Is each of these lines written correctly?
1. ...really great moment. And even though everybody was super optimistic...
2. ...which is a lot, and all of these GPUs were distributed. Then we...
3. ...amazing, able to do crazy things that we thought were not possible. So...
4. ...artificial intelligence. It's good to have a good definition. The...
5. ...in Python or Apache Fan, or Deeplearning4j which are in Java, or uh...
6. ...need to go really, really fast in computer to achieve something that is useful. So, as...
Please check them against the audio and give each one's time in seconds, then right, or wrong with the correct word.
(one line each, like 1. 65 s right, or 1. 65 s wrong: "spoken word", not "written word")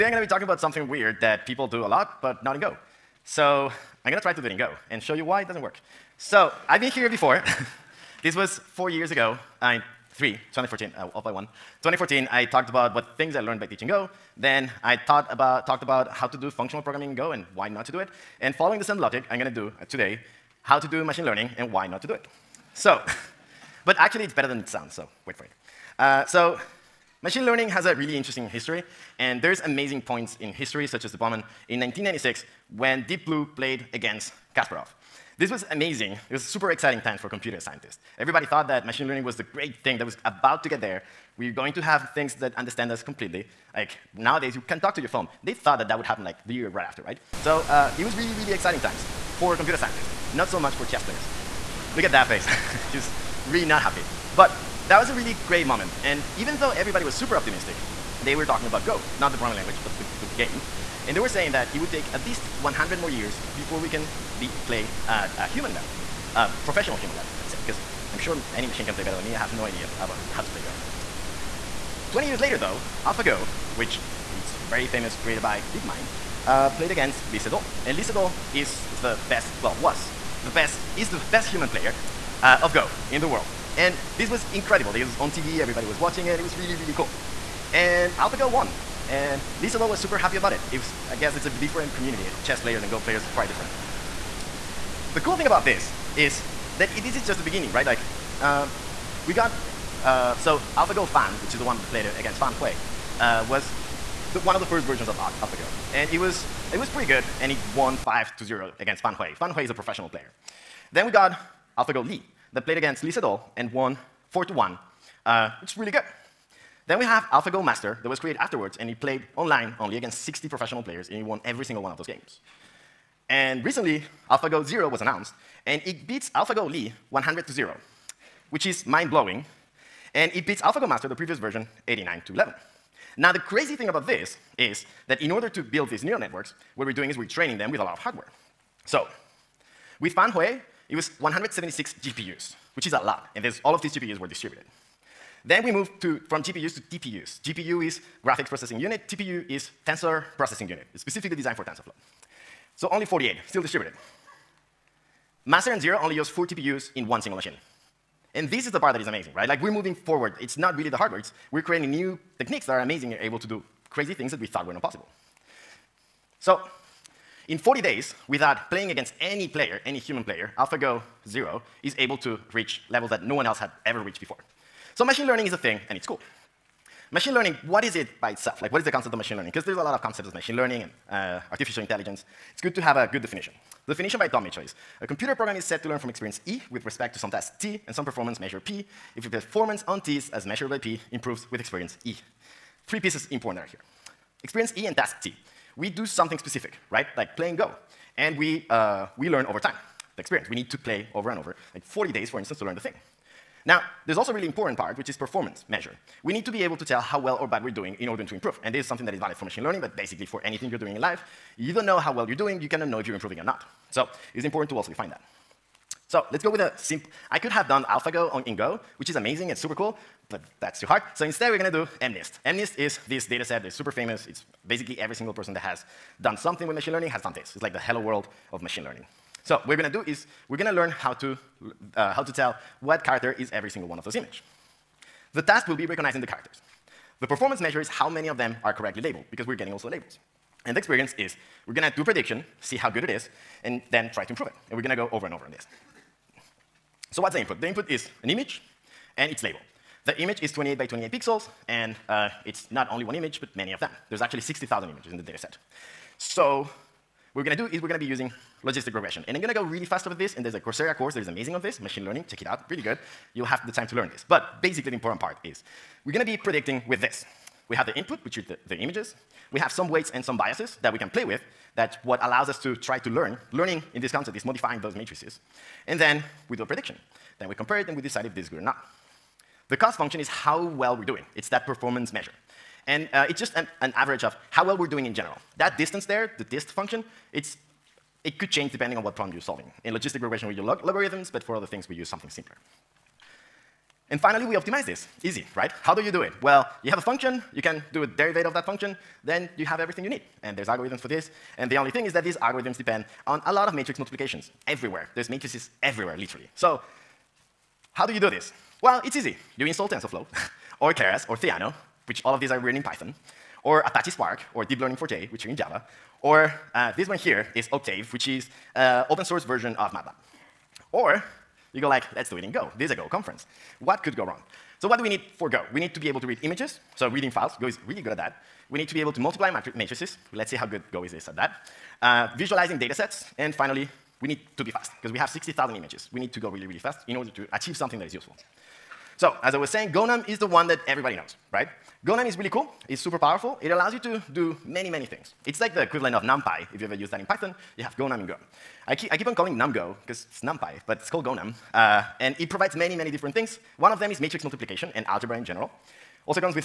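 1. 55 s right
2. 142 s right
3. 162 s right
4. 181 s right
5. 312 s wrong: "Spark", not "Fan"
6. 336 s wrong: "order", not "computer".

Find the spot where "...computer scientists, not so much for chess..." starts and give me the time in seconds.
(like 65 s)
49 s.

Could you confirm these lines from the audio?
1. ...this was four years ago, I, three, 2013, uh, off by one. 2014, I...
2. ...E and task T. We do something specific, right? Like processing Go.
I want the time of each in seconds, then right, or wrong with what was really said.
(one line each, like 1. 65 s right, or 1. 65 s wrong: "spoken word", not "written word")
1. 8 s wrong: "2014", not "2013"
2. 194 s wrong: "playing", not "processing".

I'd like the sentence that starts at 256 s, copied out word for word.
So we're going to do is we're going to be using logistic regression.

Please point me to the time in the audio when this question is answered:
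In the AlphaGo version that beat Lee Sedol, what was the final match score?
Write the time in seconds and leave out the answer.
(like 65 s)
114 s.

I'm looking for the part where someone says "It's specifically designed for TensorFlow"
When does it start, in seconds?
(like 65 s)
150 s.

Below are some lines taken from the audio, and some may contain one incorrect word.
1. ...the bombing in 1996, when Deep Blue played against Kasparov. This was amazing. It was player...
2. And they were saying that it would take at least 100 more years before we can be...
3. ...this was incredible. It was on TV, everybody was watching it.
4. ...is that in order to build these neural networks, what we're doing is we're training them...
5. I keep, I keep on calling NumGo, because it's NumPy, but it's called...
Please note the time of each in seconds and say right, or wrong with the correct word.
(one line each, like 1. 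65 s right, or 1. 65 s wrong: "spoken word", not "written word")
1. 31 s wrong: "super", not "player"
2. 61 s right
3. 84 s right
4. 134 s right
5. 348 s right.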